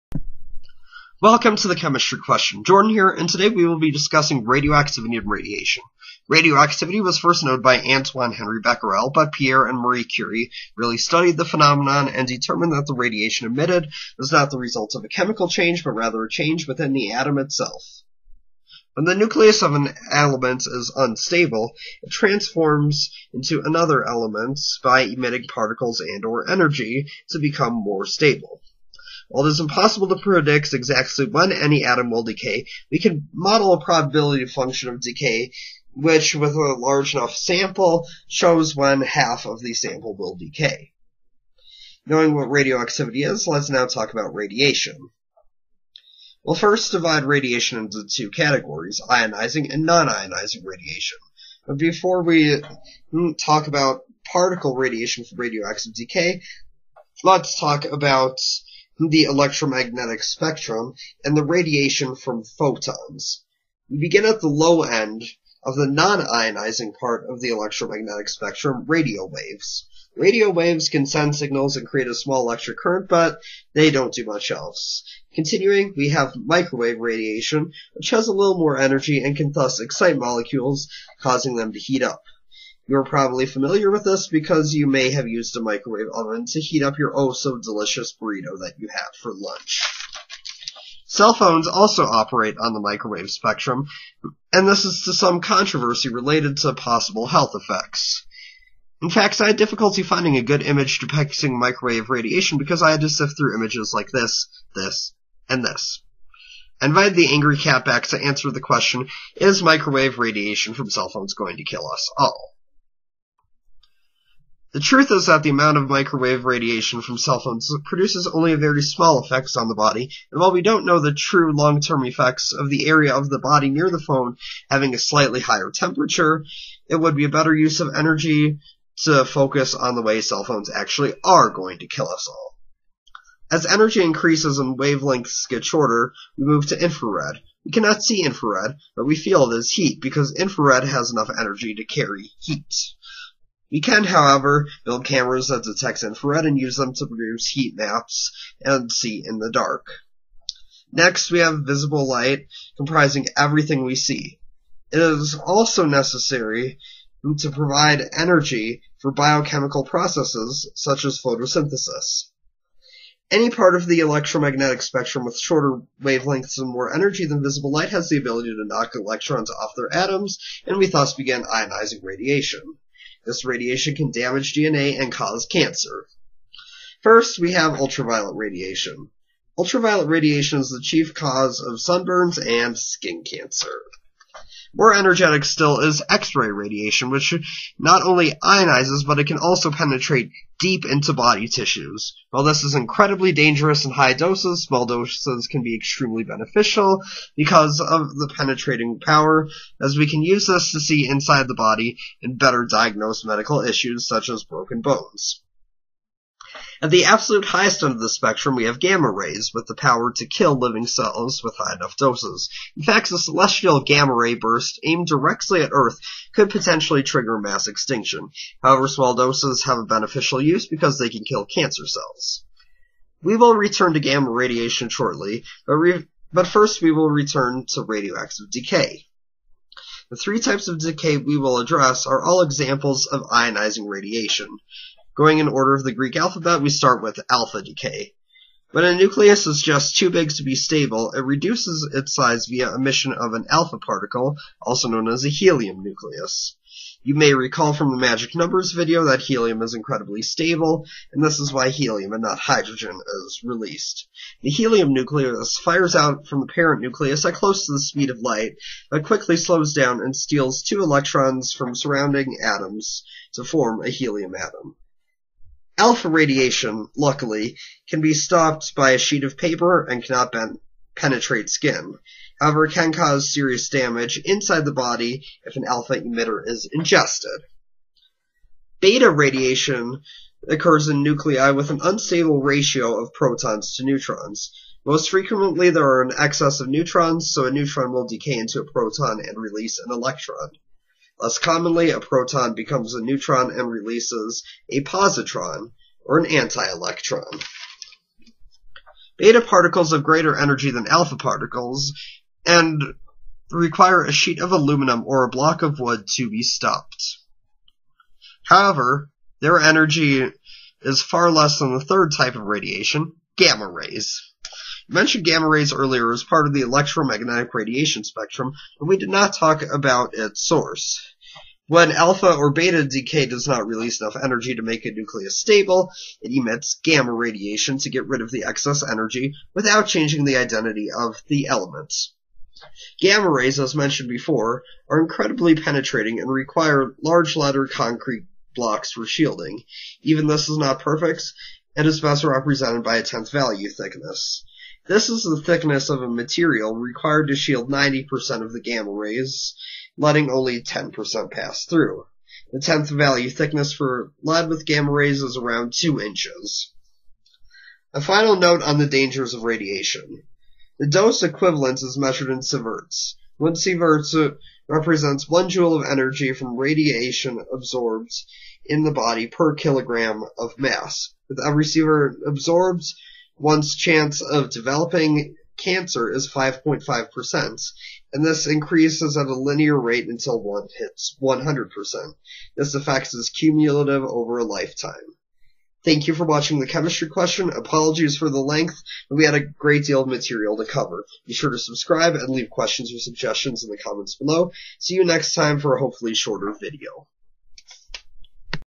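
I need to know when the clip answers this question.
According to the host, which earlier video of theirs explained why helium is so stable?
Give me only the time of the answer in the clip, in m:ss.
4:07.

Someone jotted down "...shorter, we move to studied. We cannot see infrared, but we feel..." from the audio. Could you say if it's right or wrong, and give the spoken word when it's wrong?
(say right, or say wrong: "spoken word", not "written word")
wrong: "infrared", not "studied".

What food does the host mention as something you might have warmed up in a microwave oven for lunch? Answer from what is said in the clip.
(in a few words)
burrito.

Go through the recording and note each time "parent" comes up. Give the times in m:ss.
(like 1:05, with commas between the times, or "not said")
4:16.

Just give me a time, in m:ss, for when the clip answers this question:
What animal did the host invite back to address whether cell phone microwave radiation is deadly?
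1:47.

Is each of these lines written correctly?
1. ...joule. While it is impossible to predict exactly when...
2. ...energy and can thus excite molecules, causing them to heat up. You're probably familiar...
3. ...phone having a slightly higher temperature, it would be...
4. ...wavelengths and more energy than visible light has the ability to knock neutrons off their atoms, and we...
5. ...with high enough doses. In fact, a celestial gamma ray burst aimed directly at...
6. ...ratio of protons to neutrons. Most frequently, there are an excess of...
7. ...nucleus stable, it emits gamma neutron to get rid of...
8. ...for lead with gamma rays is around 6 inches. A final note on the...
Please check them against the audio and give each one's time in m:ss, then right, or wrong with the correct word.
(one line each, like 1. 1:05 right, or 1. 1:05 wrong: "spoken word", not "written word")
1. 0:28 wrong: "stable", not "joule"
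2. 1:18 right
3. 2:03 right
4. 2:46 wrong: "electrons", not "neutrons"
5. 3:31 right
6. 4:42 right
7. 5:24 wrong: "radiation", not "neutron"
8. 5:53 wrong: "2", not "6".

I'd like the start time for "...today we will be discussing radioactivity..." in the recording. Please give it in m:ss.
0:03.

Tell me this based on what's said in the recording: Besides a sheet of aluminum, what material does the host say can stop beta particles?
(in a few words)
a block of wood.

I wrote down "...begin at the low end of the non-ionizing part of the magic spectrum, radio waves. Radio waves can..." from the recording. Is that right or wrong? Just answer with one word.
wrong.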